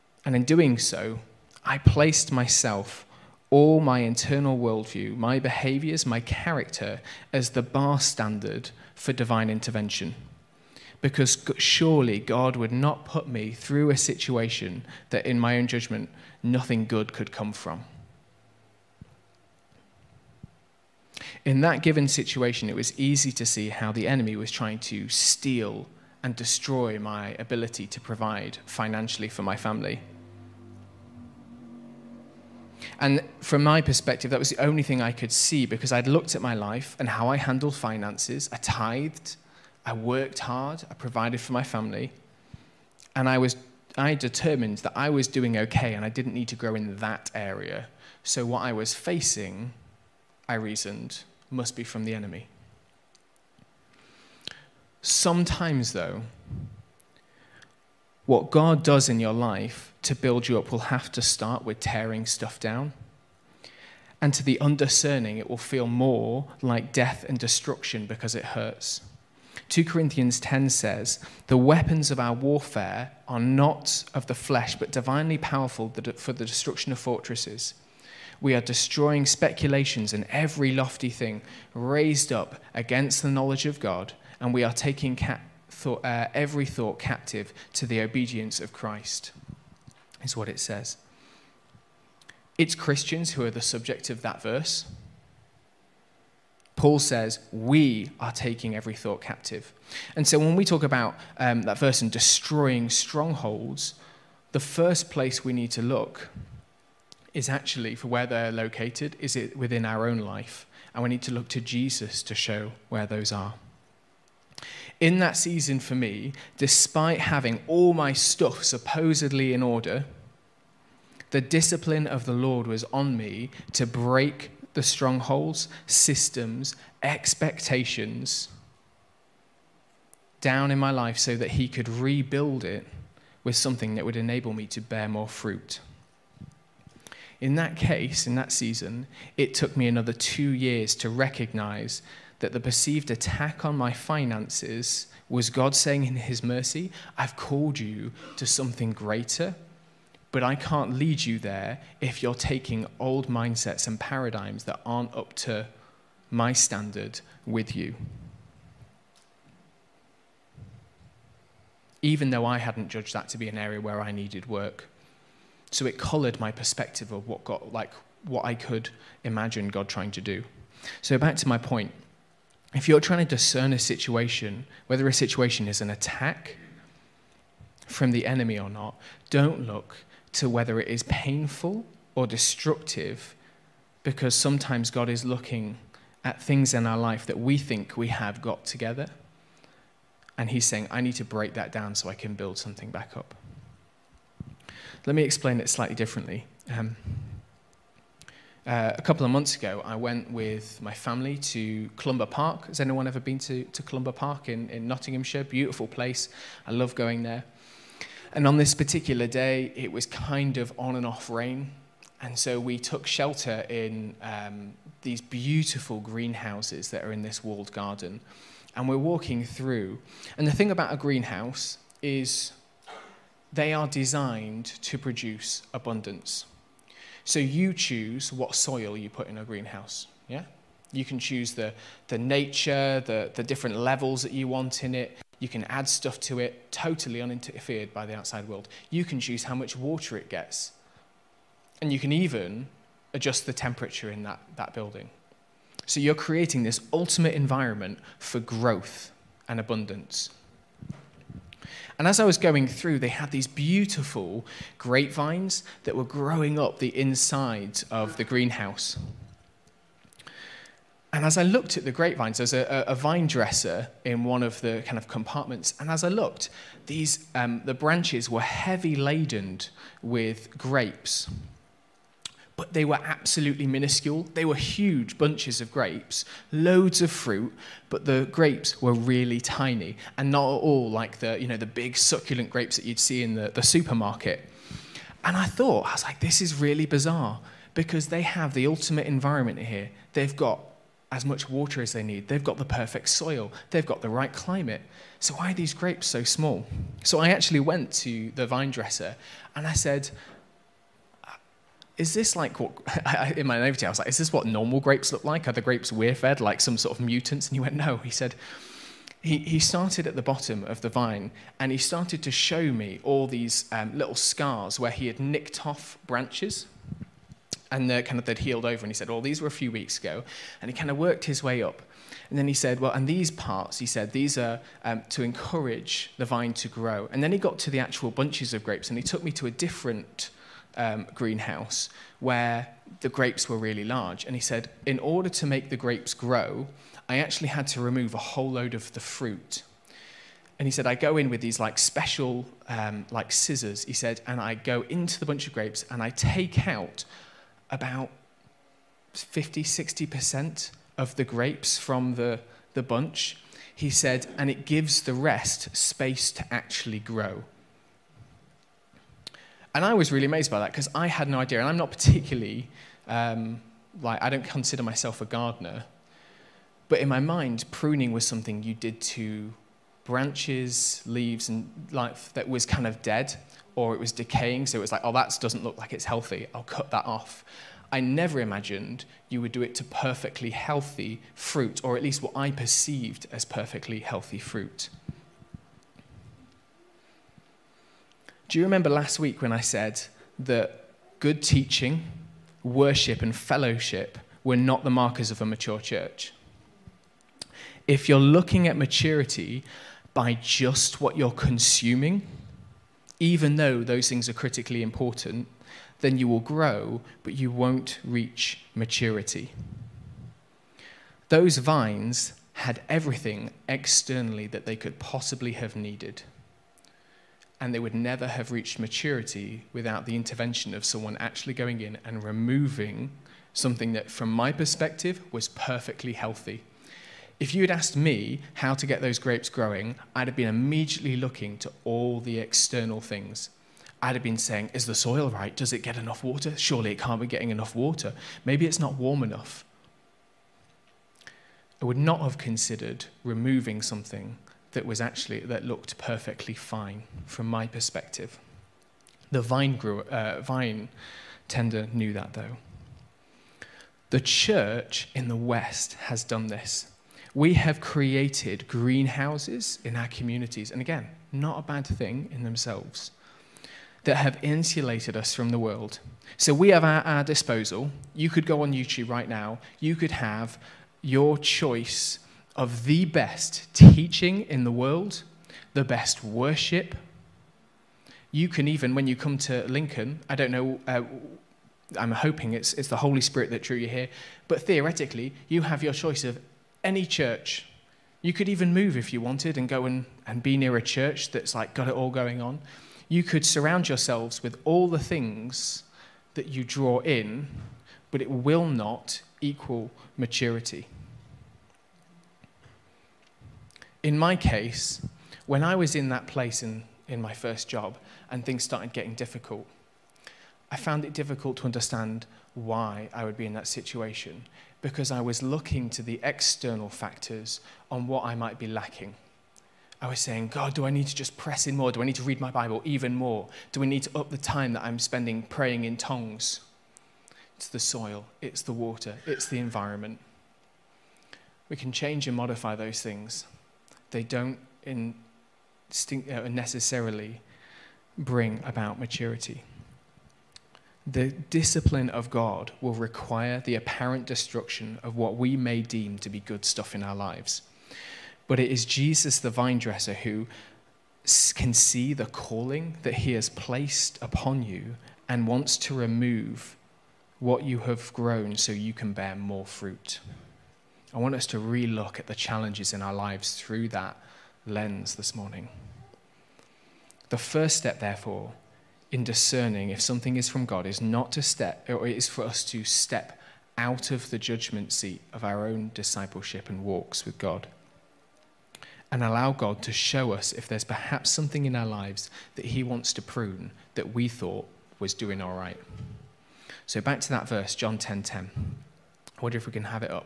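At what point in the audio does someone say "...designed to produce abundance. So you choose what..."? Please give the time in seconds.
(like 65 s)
223 s.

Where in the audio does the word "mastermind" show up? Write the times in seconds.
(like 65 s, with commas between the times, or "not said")
not said.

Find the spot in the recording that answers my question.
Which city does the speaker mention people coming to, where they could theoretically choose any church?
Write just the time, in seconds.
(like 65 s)
479 s.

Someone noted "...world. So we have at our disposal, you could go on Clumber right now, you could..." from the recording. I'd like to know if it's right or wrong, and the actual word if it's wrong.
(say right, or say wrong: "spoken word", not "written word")
wrong: "YouTube", not "Clumber".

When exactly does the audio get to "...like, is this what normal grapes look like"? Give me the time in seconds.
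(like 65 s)
303 s.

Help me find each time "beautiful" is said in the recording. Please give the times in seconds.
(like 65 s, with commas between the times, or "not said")
205 s, 215 s, 253 s.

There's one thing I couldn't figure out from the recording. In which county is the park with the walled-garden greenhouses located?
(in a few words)
Nottinghamshire.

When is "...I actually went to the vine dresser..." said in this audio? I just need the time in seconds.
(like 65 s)
297 s.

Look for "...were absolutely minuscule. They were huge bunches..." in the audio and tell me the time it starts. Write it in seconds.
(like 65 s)
272 s.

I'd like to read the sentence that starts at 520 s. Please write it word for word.
I was saying, God, do I need to just press in more?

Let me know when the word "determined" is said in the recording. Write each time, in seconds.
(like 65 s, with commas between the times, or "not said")
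44 s.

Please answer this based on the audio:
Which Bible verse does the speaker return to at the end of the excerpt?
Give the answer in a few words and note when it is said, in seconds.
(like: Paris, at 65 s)
John 10:10, at 587 s.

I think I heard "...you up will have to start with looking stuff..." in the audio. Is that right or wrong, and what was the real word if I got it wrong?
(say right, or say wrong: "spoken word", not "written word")
wrong: "tearing", not "looking".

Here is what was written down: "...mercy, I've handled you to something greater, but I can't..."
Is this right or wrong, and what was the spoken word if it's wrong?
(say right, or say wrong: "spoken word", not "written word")
wrong: "called", not "handled".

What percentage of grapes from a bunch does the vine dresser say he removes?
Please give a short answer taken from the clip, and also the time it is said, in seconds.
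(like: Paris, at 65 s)
50-60%, at 349 s.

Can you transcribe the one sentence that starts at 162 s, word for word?
Even though I hadn't judged that to be an area where I needed work.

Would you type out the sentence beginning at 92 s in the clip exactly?
It's Christians who are the subject of that verse.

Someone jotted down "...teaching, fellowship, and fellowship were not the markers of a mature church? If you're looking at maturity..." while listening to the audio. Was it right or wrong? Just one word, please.
wrong.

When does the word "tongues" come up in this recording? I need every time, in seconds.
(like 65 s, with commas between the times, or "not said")
525 s.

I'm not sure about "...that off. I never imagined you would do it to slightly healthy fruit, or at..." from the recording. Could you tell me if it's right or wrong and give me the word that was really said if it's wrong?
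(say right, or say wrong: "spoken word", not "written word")
wrong: "perfectly", not "slightly".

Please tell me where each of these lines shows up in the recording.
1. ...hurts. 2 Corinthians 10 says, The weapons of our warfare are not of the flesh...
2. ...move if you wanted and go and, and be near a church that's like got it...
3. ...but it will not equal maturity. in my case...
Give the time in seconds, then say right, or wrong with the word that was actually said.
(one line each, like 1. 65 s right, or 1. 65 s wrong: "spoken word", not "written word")
1. 68 s right
2. 488 s right
3. 498 s right.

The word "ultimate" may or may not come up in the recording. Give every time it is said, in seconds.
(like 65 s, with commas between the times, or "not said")
246 s, 288 s.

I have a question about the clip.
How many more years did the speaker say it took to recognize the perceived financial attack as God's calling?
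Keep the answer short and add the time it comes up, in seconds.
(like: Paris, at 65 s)
2, at 139 s.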